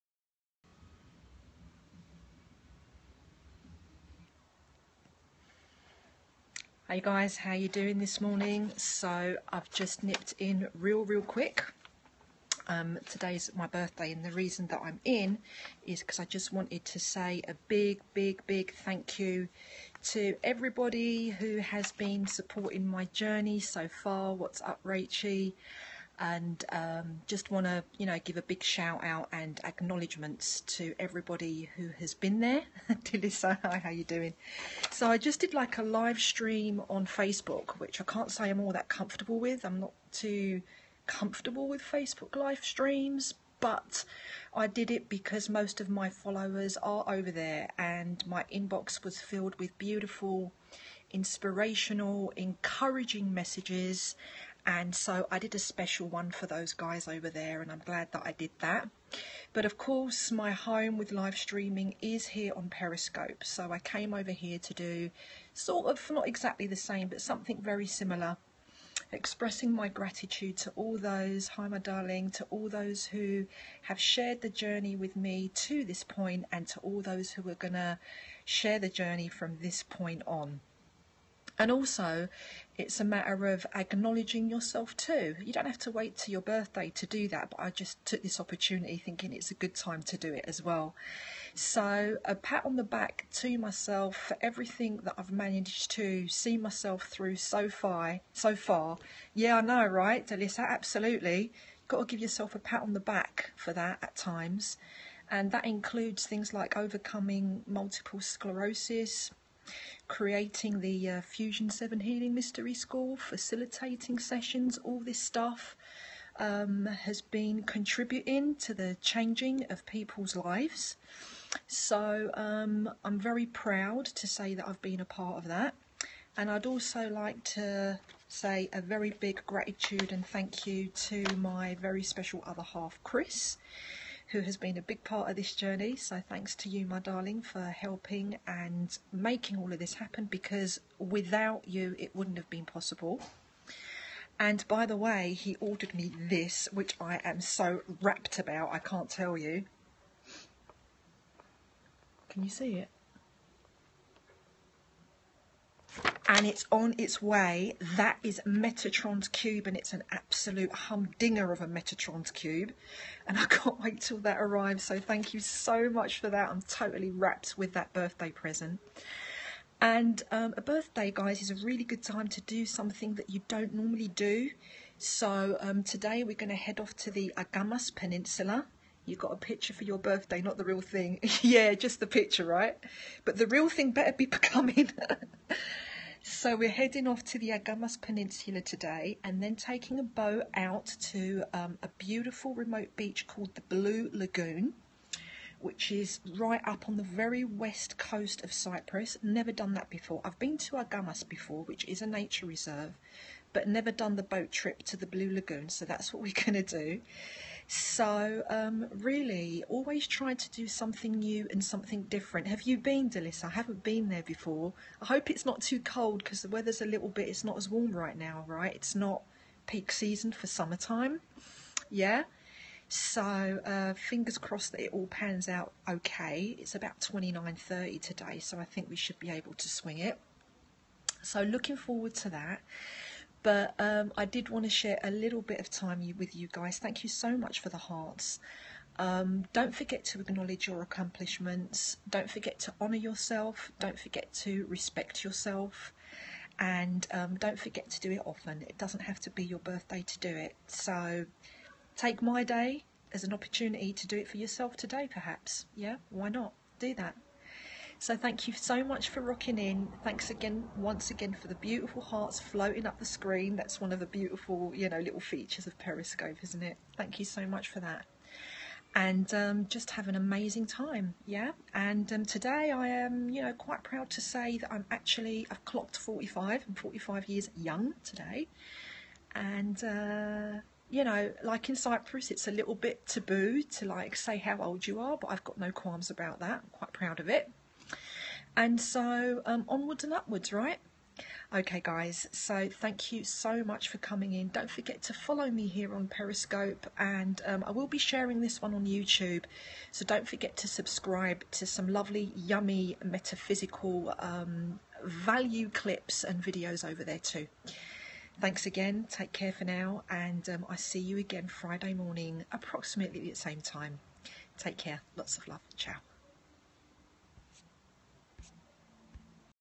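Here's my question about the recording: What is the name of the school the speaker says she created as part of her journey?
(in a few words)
Fusion 7 Healing Mystery School.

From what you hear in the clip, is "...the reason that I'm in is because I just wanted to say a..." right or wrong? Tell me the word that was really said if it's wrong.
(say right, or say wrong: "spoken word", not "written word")
right.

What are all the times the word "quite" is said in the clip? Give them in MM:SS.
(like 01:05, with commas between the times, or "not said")
04:33, 04:46.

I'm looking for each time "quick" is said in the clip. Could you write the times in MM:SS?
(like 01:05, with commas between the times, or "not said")
00:11.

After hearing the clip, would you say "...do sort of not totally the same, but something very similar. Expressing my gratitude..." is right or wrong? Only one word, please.
wrong.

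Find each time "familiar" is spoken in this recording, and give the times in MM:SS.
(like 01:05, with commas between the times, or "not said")
not said.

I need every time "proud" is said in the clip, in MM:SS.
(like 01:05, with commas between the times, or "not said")
02:03, 04:33, 04:46.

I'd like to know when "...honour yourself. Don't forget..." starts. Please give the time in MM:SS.
04:02.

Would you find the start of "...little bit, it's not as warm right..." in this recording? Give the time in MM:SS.
03:36.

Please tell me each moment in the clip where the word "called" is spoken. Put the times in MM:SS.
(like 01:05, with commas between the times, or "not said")
03:13.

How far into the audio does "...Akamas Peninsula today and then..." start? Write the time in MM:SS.
03:07.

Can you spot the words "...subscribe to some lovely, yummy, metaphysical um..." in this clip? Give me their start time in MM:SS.
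05:00.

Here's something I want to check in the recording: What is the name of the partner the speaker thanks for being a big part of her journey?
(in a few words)
Chris.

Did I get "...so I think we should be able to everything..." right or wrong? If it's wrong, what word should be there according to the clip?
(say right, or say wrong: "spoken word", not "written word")
wrong: "swing", not "everything".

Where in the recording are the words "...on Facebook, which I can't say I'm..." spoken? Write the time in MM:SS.
00:36.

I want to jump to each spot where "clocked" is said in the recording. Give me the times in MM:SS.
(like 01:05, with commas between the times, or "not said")
04:35.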